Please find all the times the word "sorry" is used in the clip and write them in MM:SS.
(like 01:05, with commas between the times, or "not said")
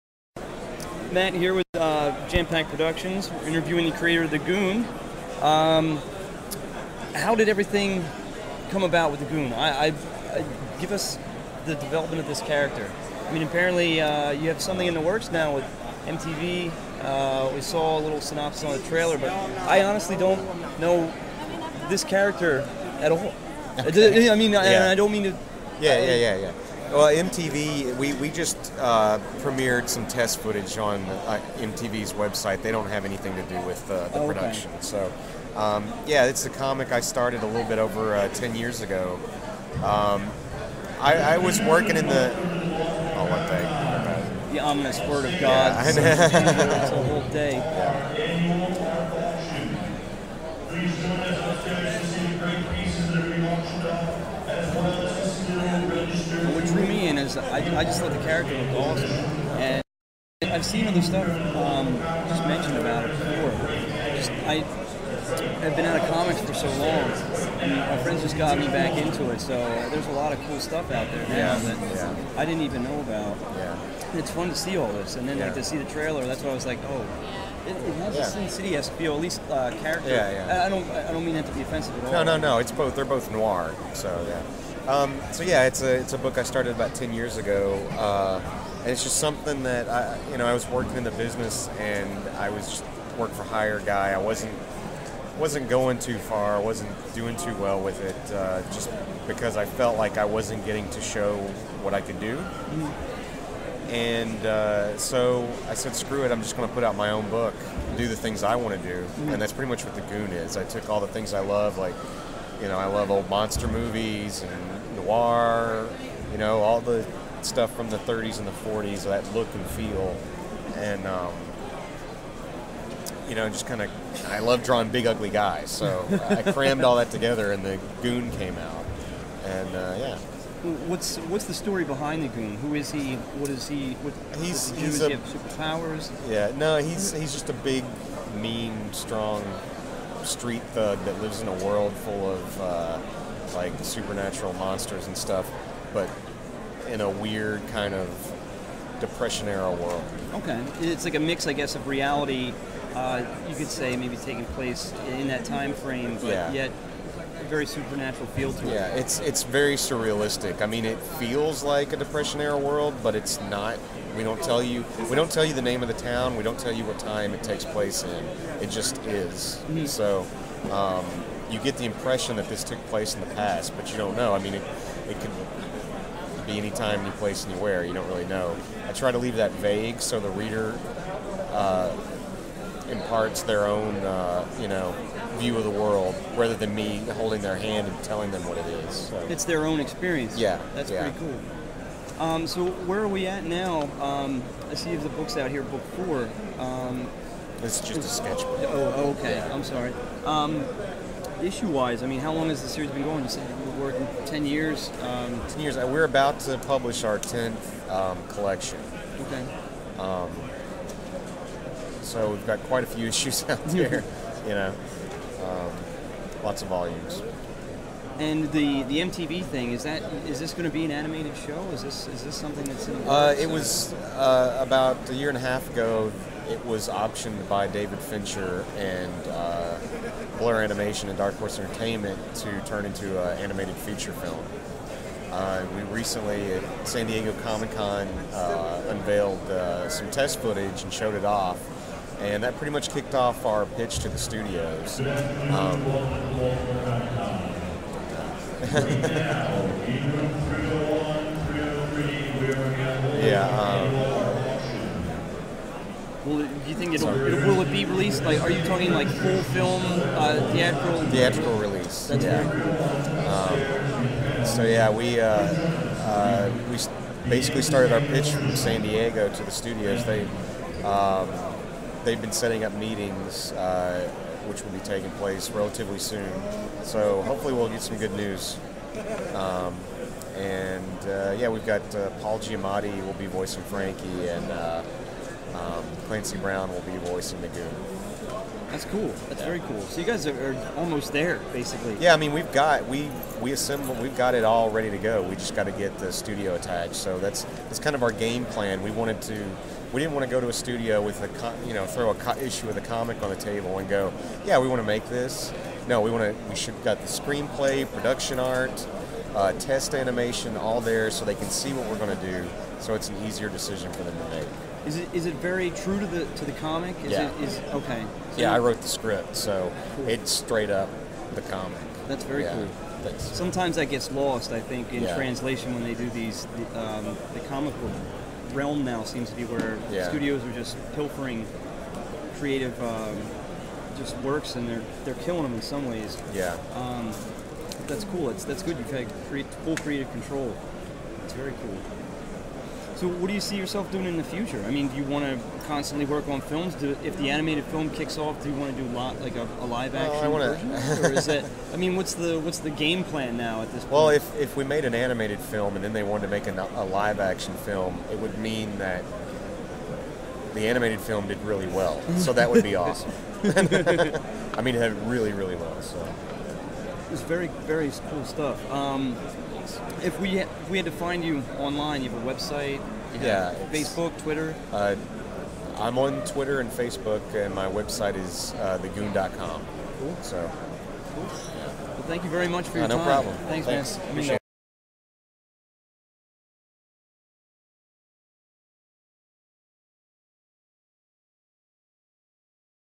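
03:19.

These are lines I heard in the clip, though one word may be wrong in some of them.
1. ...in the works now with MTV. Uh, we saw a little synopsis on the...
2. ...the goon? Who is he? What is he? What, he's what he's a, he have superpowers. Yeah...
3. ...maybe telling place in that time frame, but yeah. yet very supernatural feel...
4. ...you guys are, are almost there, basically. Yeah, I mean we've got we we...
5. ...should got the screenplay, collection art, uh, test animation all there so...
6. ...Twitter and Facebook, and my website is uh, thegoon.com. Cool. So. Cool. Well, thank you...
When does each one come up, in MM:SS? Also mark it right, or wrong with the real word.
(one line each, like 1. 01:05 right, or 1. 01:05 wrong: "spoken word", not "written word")
1. 00:14 right
2. 02:12 right
3. 02:33 wrong: "taking", not "telling"
4. 04:49 right
5. 05:06 wrong: "production", not "collection"
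6. 06:16 right.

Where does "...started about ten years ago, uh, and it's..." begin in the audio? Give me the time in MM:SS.
01:26.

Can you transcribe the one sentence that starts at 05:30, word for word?
studios are just pilfering creative um, just works, and they're they're killing them in some ways.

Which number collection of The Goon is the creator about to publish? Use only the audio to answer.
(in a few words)
10th.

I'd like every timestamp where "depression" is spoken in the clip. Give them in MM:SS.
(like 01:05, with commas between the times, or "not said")
02:28, 02:41.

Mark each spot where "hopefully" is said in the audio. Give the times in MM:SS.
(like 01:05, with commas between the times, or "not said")
04:37.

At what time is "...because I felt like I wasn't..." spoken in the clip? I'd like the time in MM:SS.
01:39.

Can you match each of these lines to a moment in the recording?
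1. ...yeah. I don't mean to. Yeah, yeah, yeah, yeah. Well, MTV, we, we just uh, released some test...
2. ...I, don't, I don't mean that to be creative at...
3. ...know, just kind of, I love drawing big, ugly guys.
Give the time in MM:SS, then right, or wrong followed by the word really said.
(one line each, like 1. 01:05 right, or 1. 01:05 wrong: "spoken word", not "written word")
1. 00:24 wrong: "premiered", not "released"
2. 01:20 wrong: "offensive", not "creative"
3. 02:03 right.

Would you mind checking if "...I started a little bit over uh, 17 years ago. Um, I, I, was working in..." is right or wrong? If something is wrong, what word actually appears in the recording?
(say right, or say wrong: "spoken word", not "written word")
wrong: "10", not "17".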